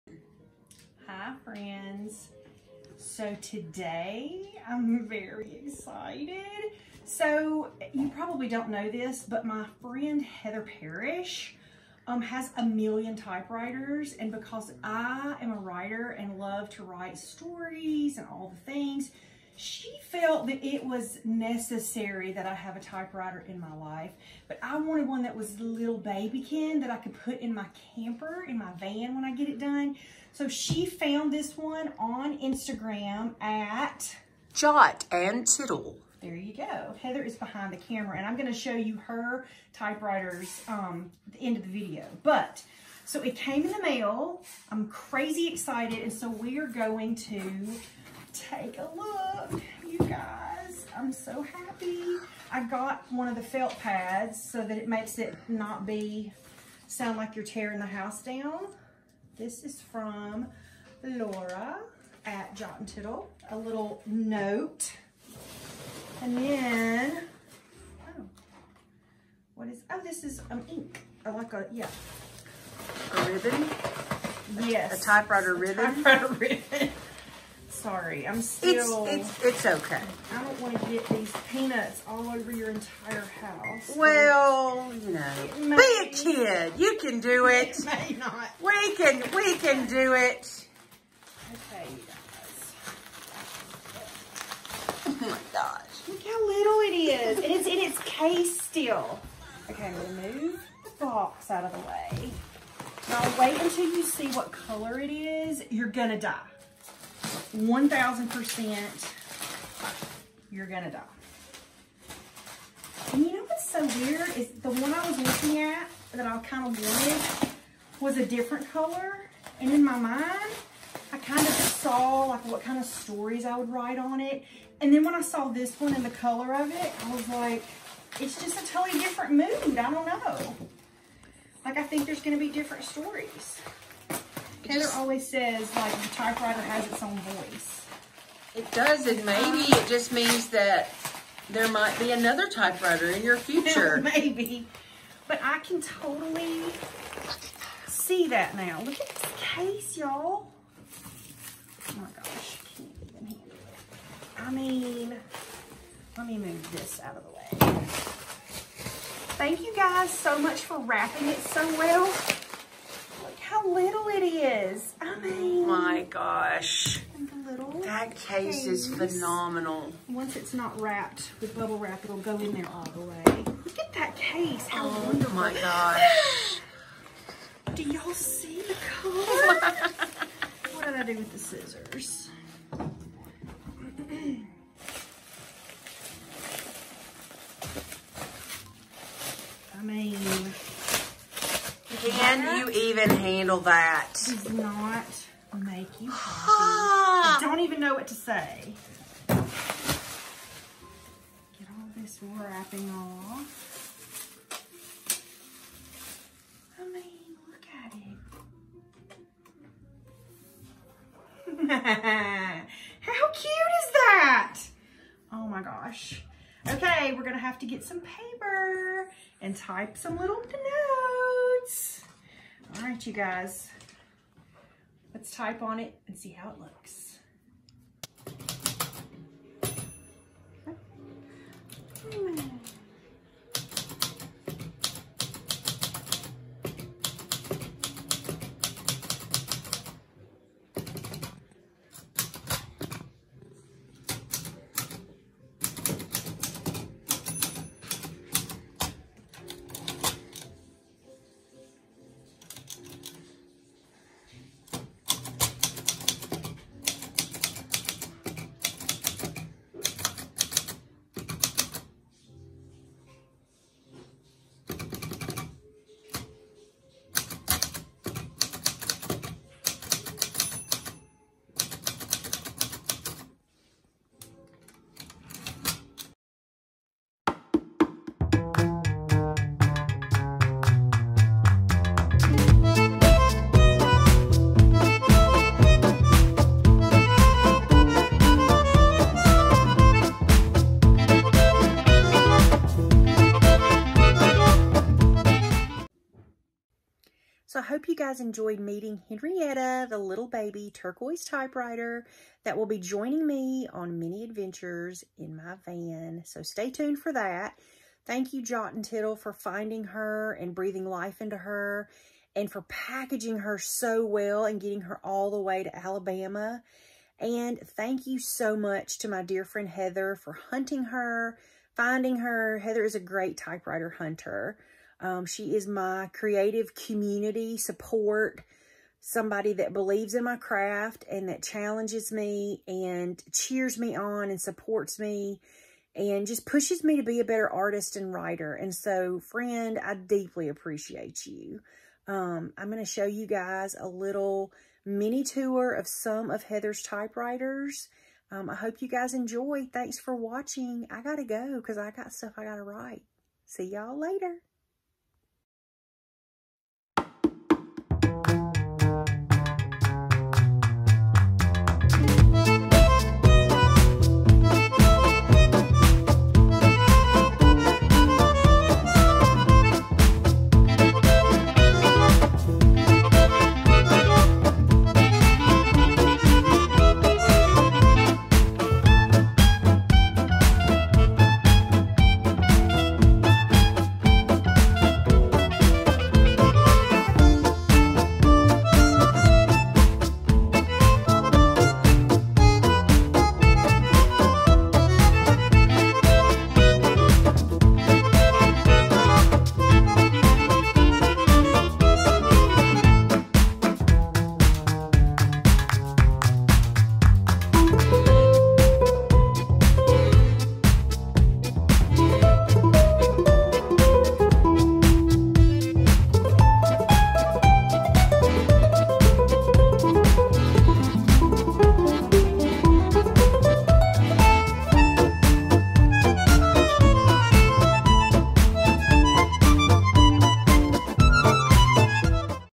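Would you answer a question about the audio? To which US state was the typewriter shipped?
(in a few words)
Alabama.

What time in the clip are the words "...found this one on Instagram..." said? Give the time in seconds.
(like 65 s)
30 s.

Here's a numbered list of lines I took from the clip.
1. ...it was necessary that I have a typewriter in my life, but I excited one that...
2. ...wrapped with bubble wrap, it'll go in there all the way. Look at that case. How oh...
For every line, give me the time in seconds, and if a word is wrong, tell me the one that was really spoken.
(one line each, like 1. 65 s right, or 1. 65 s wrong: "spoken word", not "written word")
1. 20 s wrong: "wanted", not "excited"
2. 170 s right.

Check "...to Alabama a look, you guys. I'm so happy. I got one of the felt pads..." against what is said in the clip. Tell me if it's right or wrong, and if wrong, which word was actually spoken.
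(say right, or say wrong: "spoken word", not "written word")
wrong: "Take", not "Alabama".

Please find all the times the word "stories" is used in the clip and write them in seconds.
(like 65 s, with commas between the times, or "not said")
17 s, 122 s, 132 s.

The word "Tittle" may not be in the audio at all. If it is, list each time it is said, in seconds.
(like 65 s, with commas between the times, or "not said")
35 s, 62 s, 308 s.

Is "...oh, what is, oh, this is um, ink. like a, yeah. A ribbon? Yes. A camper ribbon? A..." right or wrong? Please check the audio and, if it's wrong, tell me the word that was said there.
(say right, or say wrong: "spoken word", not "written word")
wrong: "typewriter", not "camper".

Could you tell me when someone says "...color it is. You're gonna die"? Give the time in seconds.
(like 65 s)
104 s.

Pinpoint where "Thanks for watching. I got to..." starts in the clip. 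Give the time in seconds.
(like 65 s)
349 s.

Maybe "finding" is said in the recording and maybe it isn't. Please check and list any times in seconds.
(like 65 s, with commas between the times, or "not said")
309 s, 321 s.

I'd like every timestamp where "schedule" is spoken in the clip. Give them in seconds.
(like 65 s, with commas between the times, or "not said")
not said.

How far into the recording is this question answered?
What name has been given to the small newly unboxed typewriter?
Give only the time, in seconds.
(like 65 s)
299 s.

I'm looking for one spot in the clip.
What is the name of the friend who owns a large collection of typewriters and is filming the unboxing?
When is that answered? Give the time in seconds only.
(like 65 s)
10 s.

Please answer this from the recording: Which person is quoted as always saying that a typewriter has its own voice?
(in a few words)
Taylor.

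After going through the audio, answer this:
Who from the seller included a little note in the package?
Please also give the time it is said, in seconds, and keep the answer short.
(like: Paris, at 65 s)
Laura, at 61 s.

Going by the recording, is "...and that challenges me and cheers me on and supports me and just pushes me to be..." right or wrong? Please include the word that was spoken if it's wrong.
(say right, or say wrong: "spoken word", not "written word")
right.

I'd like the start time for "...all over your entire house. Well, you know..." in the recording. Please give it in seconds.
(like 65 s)
82 s.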